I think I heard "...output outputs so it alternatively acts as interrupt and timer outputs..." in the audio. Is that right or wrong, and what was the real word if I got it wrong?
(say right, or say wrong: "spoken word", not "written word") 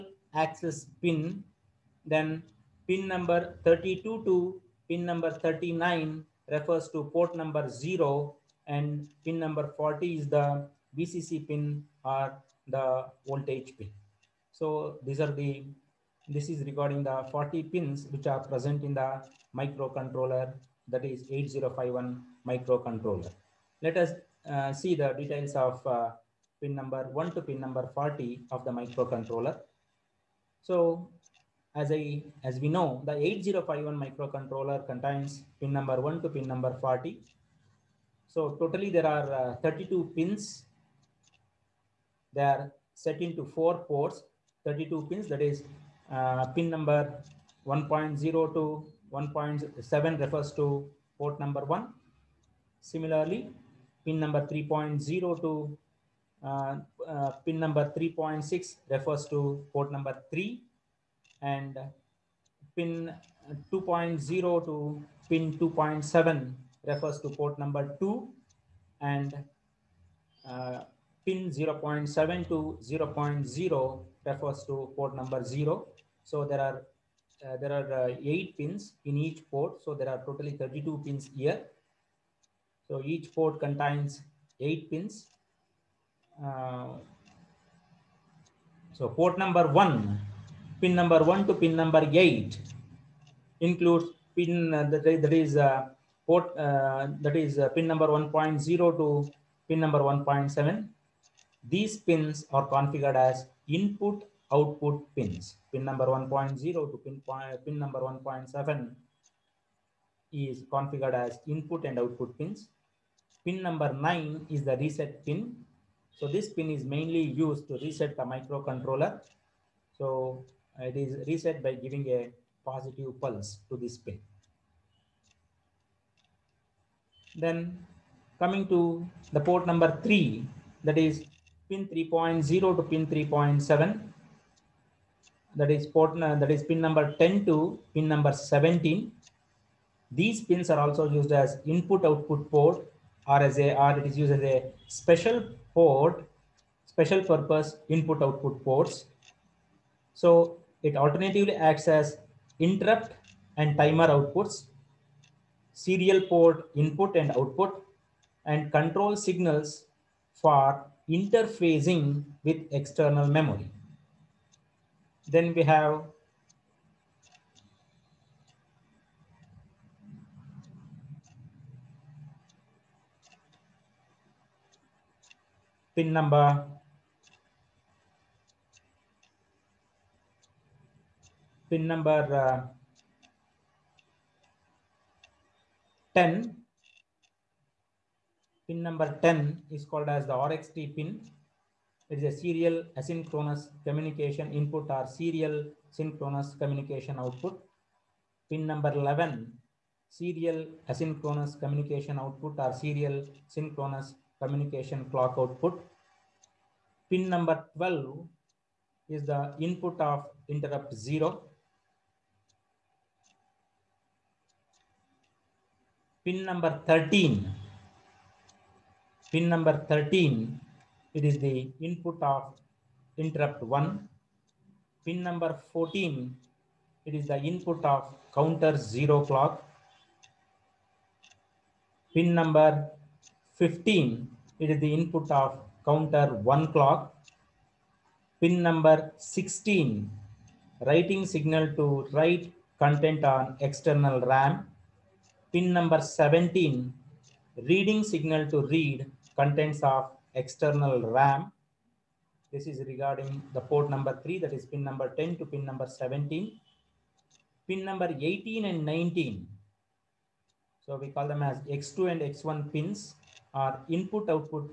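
wrong: "ports", not "outputs".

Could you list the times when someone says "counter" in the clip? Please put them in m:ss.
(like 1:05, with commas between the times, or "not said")
3:48, 3:55.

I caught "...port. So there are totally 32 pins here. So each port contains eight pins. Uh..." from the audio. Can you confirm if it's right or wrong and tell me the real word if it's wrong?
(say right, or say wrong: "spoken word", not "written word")
right.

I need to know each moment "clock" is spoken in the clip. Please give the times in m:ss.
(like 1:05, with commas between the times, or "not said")
3:25, 3:49, 3:56.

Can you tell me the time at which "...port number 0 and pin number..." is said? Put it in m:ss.
0:07.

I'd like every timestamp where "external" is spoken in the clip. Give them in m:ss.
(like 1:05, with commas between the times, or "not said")
2:42, 4:03, 4:10.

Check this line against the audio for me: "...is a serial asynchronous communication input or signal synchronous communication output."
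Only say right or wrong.
wrong.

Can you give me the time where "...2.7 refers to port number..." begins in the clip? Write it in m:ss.
1:05.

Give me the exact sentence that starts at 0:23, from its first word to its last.
Let us uh, see the details of uh, pin number 1 to pin number 40 of the microcontroller.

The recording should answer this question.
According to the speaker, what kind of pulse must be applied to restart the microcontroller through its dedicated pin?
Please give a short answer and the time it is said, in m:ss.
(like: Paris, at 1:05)
Positive pulse, at 2:02.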